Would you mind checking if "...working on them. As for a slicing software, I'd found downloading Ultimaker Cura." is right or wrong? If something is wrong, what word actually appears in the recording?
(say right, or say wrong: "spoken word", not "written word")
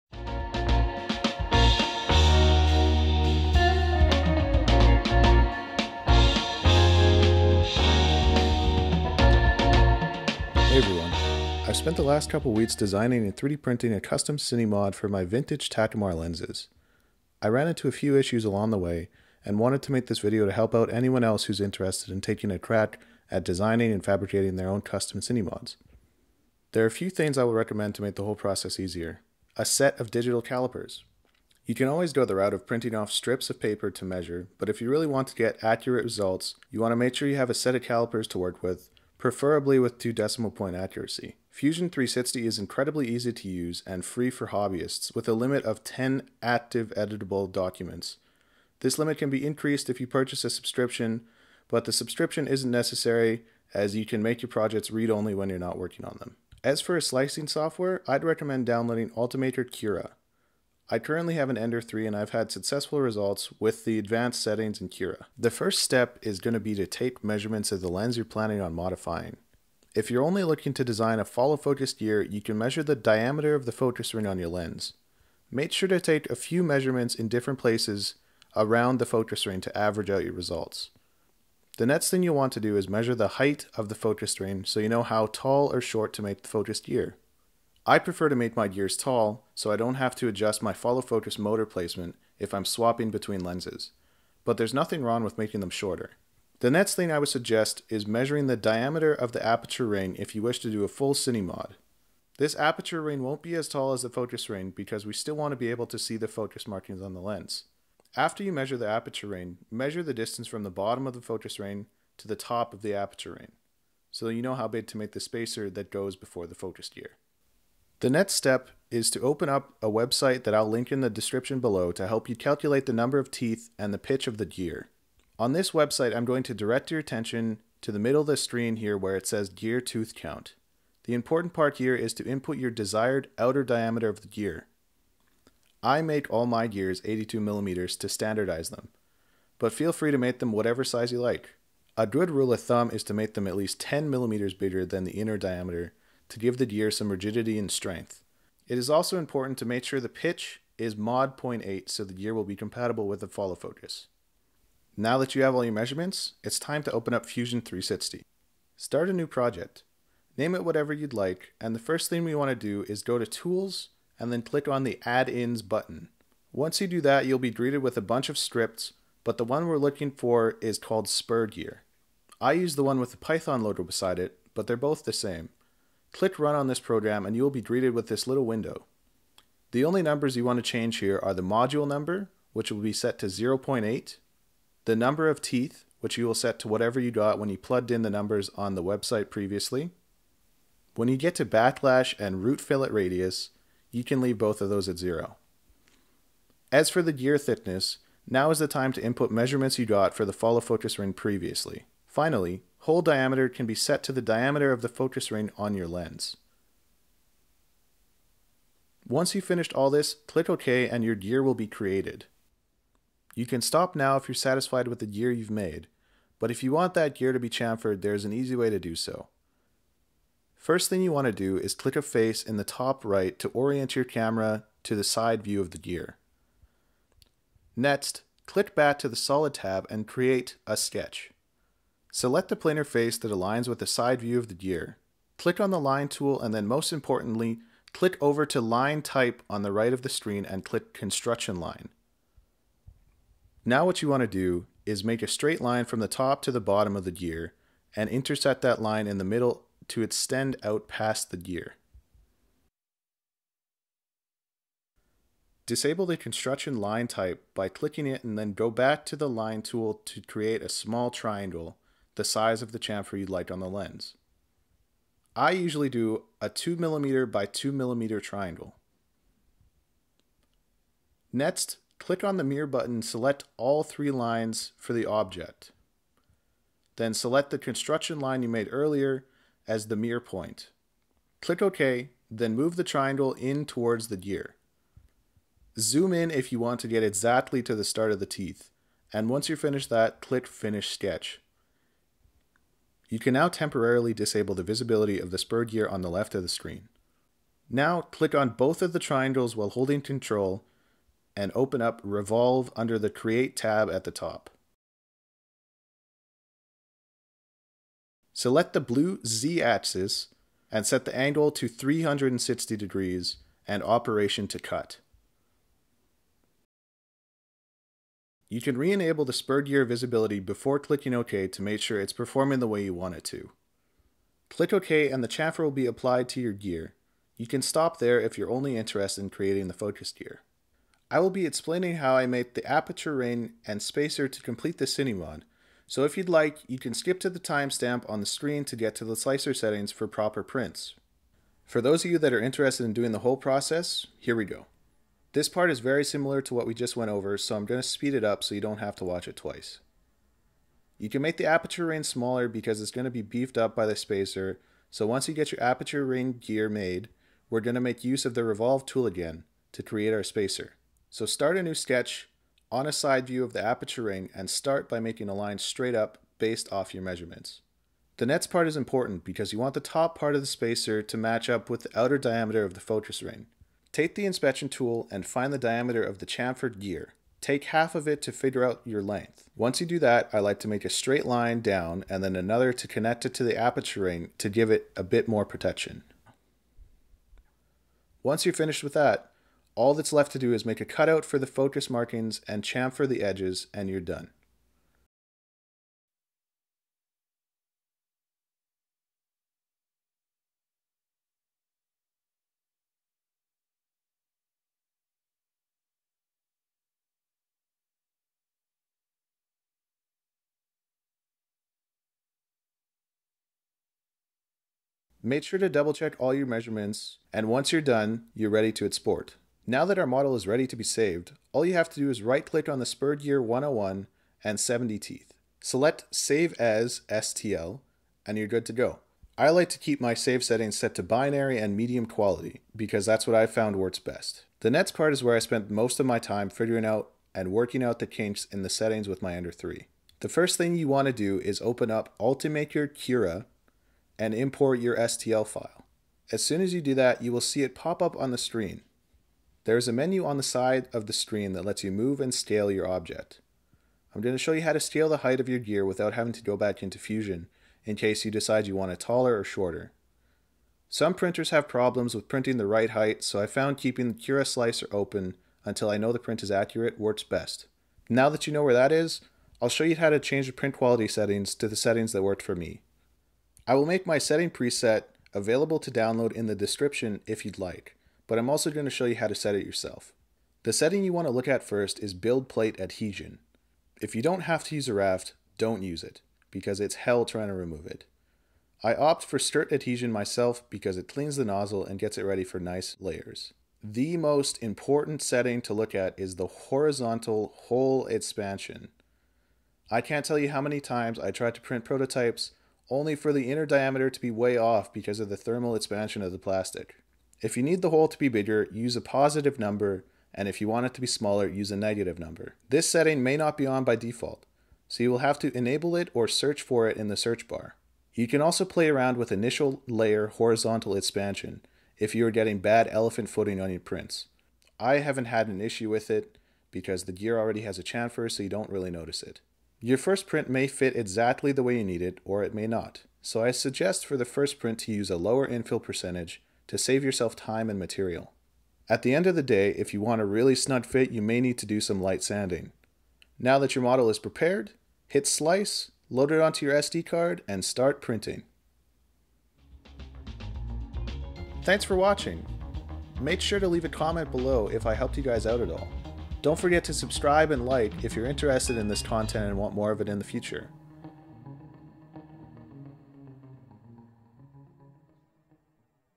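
wrong: "recommend", not "found".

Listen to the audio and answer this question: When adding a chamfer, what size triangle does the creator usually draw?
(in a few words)
2mm by 2mm.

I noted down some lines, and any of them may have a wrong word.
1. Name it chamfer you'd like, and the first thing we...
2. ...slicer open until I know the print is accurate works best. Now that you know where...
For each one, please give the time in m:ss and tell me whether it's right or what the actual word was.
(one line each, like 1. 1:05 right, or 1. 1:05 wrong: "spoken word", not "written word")
1. 2:40 wrong: "whatever", not "chamfer"
2. 7:44 right.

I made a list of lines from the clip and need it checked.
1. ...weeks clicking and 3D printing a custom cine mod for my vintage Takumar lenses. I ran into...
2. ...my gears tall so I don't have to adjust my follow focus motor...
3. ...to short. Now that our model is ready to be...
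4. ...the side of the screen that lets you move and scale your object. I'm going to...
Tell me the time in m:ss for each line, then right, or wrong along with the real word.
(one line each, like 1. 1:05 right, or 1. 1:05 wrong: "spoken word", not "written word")
1. 0:12 wrong: "designing", not "clicking"
2. 1:28 right
3. 6:58 wrong: "export", not "short"
4. 7:30 right.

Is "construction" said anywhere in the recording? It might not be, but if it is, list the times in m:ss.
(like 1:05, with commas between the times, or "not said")
4:00, 4:16, 4:37.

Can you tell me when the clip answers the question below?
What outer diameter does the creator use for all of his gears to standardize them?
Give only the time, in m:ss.
2:17.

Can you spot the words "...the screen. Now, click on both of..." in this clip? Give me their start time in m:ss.
4:56.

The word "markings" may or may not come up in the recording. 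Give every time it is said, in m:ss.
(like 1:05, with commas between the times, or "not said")
1:46, 6:31.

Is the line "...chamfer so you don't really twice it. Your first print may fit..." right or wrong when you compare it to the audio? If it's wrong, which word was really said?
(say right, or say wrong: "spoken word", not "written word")
wrong: "notice", not "twice".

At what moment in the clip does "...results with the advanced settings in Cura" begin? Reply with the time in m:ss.
1:03.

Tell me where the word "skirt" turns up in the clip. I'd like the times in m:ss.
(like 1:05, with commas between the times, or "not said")
8:09.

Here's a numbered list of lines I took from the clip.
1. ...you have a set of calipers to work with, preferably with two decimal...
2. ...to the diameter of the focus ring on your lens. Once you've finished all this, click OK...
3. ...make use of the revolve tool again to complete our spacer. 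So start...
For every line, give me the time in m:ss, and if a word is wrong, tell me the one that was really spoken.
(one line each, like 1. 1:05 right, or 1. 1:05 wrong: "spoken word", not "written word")
1. 0:37 right
2. 3:24 right
3. 5:57 wrong: "create", not "complete".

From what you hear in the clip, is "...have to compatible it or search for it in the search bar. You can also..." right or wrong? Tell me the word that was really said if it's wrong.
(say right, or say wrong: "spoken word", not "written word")
wrong: "enable", not "compatible".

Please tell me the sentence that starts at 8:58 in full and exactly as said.
At the end of the day, if you want a really snug fit, you may need to do some light sanding.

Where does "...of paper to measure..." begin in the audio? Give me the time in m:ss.
0:33.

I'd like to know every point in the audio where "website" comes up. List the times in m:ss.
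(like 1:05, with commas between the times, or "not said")
1:59, 2:05, 3:08.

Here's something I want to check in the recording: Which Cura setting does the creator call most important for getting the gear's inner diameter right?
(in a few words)
Horizontal hole expansion.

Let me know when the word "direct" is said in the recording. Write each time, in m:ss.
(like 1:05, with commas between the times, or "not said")
2:06.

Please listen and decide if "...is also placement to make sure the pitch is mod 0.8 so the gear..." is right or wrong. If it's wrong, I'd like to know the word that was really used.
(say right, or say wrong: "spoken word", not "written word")
wrong: "important", not "placement".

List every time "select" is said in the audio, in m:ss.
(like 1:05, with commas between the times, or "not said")
3:52, 4:33, 4:37, 5:08, 7:05.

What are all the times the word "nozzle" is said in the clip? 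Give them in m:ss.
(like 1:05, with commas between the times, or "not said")
8:11.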